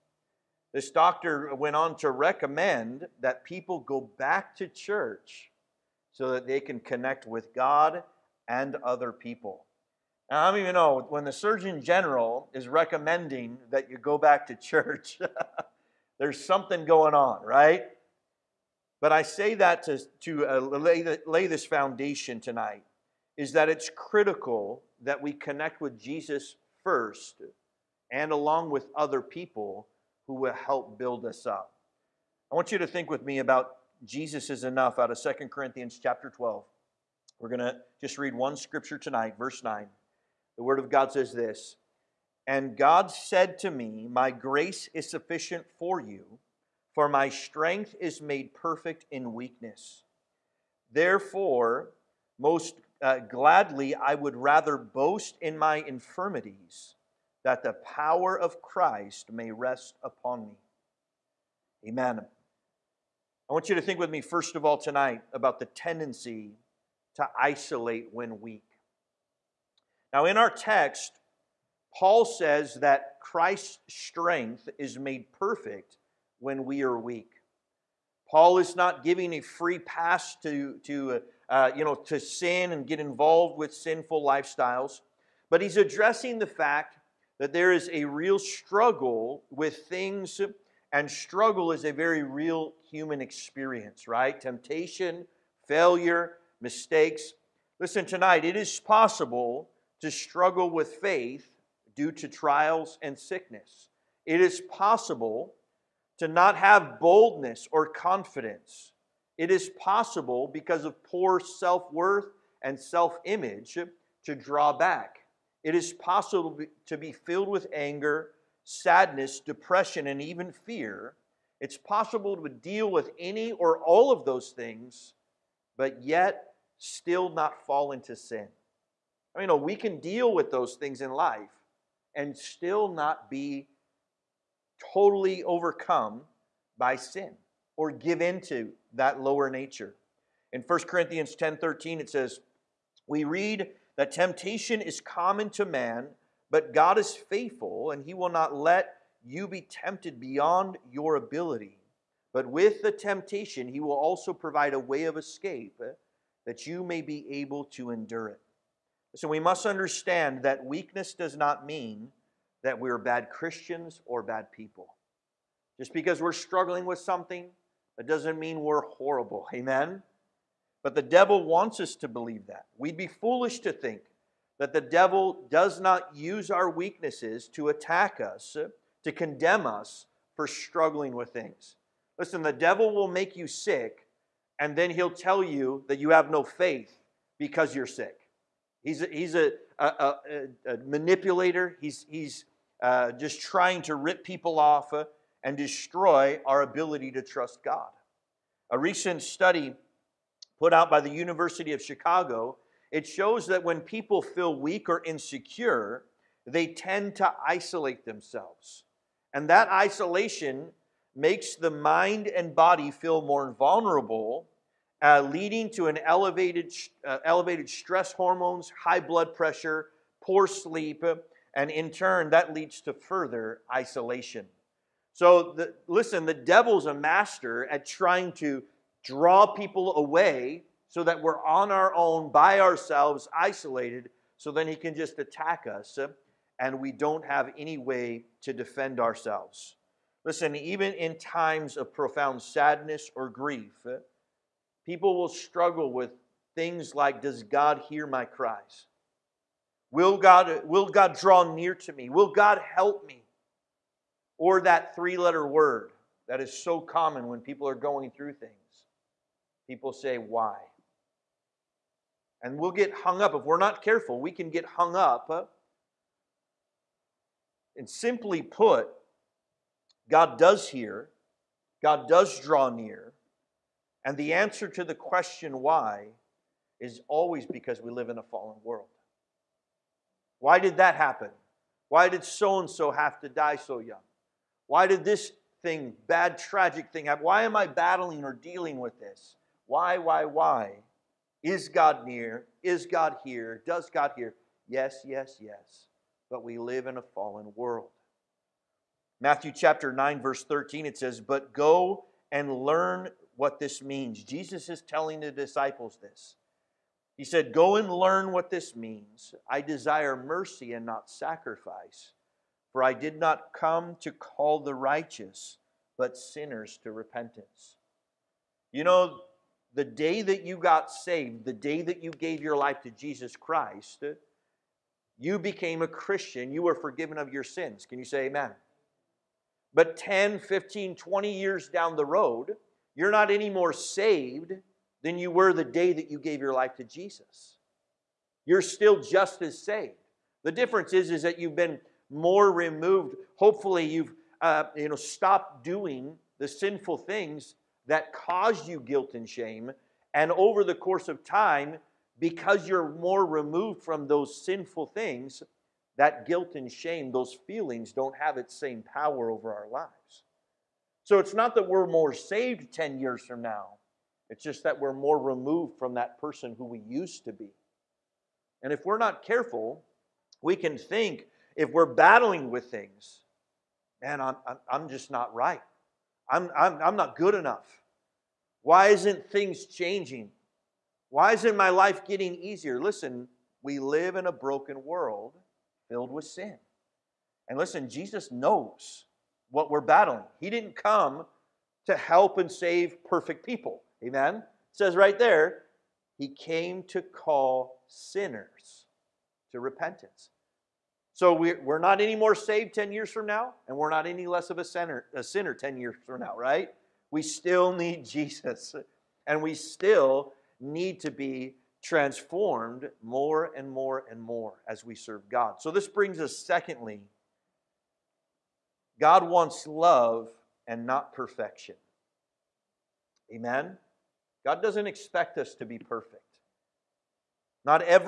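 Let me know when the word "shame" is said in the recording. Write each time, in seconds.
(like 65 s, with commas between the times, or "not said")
349 s, 356 s.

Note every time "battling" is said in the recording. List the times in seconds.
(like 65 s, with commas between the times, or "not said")
287 s, 371 s, 389 s.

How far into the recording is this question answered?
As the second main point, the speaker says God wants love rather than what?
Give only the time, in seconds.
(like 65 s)
421 s.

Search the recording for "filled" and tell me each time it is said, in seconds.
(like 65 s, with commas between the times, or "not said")
117 s, 385 s.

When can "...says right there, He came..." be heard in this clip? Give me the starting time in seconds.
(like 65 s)
394 s.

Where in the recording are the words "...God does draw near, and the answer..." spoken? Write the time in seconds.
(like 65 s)
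271 s.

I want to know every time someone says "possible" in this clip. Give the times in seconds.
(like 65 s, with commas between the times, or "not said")
98 s, 104 s, 109 s, 115 s, 121 s.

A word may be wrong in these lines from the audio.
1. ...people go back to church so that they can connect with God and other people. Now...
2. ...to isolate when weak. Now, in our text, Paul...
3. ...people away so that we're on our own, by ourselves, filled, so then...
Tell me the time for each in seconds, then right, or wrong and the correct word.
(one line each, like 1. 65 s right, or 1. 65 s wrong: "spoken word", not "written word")
1. 3 s right
2. 67 s right
3. 229 s wrong: "isolated", not "filled".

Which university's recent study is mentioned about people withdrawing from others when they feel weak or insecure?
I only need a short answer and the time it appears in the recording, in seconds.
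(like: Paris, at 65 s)
University of Chicago, at 201 s.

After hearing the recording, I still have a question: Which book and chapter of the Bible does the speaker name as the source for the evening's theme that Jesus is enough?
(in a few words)
Second Corinthians 12.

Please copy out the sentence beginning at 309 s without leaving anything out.
I desire mercy and not sacrifice, for I did not come to call the righteous, but sinners to repentance.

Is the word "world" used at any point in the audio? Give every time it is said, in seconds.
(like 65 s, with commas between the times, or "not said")
278 s, 297 s, 384 s.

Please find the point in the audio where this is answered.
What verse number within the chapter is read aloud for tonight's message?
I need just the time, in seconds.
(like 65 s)
39 s.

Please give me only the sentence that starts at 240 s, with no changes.
Listen, even in times of profound sadness or grief, People will struggle with things like Does God hear my cries?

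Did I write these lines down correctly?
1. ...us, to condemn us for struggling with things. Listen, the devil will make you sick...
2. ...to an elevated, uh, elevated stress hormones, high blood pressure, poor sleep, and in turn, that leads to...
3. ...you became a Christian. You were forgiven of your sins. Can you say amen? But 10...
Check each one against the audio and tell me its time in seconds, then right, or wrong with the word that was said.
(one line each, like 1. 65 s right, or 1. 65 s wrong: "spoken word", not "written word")
1. 178 s right
2. 215 s right
3. 325 s right.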